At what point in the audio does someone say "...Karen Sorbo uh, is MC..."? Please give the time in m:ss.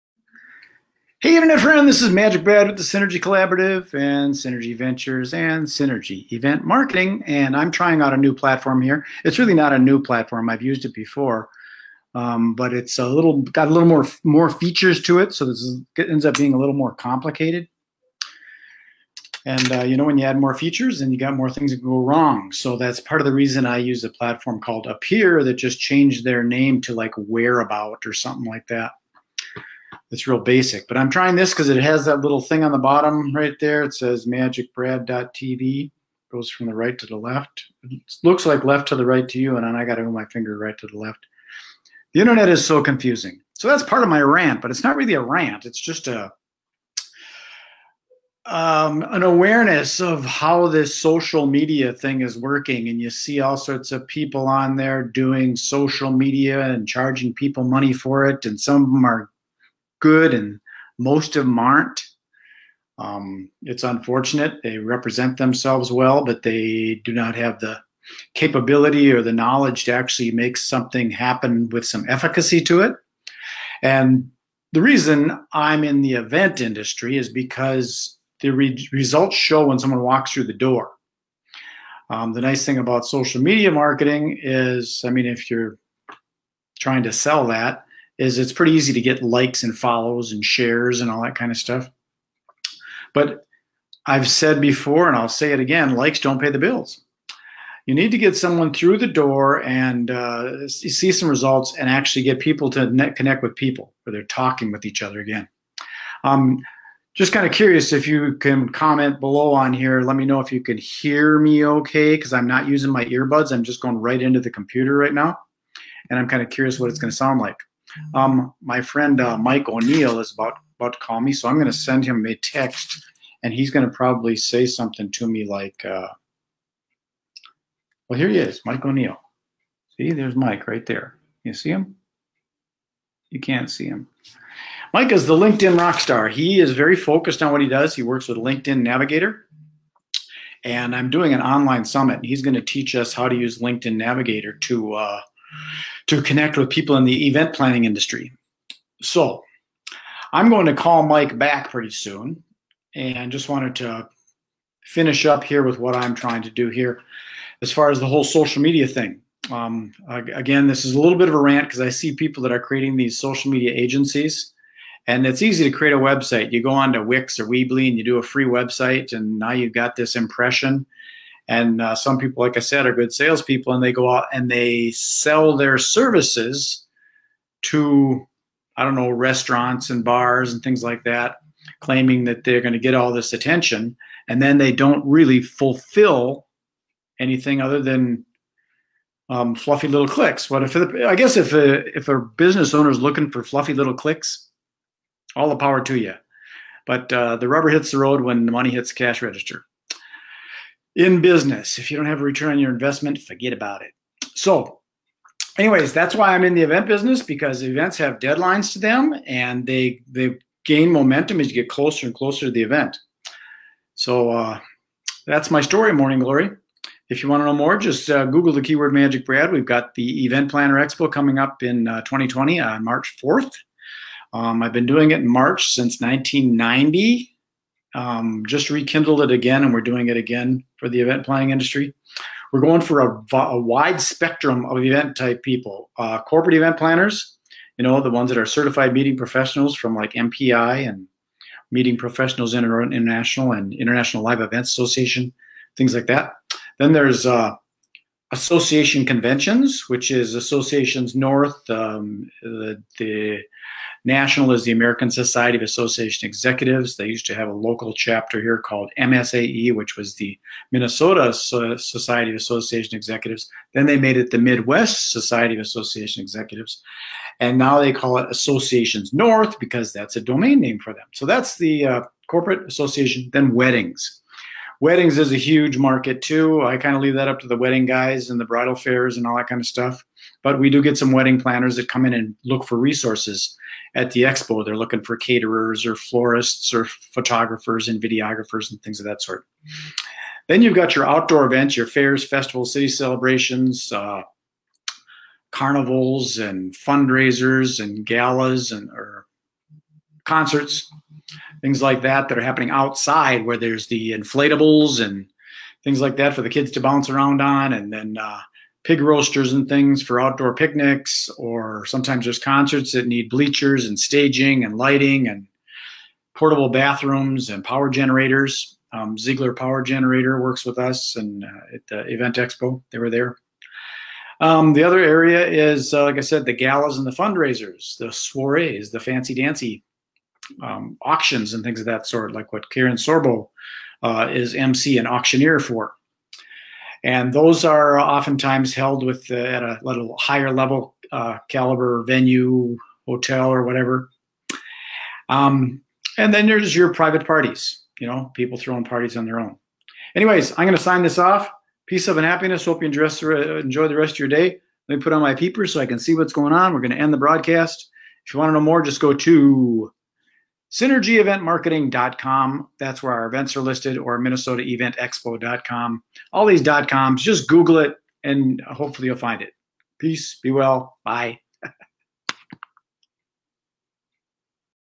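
5:32.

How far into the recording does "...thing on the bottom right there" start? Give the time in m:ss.
0:32.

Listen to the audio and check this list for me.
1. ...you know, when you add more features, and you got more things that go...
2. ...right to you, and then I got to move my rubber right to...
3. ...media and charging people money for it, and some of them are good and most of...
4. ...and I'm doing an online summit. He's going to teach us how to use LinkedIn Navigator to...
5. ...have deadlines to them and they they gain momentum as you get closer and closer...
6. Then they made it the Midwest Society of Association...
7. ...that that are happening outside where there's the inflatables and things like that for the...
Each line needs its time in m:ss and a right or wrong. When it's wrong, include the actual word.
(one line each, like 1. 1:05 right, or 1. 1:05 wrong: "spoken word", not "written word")
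1. 0:19 right
2. 0:39 wrong: "finger", not "rubber"
3. 0:56 right
4. 2:20 right
5. 3:27 right
6. 4:23 right
7. 5:02 right.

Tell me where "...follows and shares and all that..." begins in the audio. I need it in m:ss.
1:29.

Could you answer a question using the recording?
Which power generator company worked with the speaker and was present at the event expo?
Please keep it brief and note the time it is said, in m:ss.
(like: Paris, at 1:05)
Ziegler, at 5:19.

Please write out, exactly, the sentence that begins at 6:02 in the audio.
That's where our events are listed, or minnesotaeventexpo.com.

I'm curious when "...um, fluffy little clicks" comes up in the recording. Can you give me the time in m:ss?
3:09.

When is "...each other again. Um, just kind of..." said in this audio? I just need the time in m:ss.
1:44.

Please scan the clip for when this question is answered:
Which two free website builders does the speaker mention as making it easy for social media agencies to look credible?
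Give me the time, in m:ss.
2:47.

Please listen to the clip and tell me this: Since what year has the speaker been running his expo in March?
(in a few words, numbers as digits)
1990.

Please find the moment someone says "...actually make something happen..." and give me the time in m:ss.
1:09.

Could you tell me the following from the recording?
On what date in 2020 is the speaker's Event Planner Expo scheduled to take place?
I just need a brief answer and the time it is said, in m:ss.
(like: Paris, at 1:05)
March 4, at 3:42.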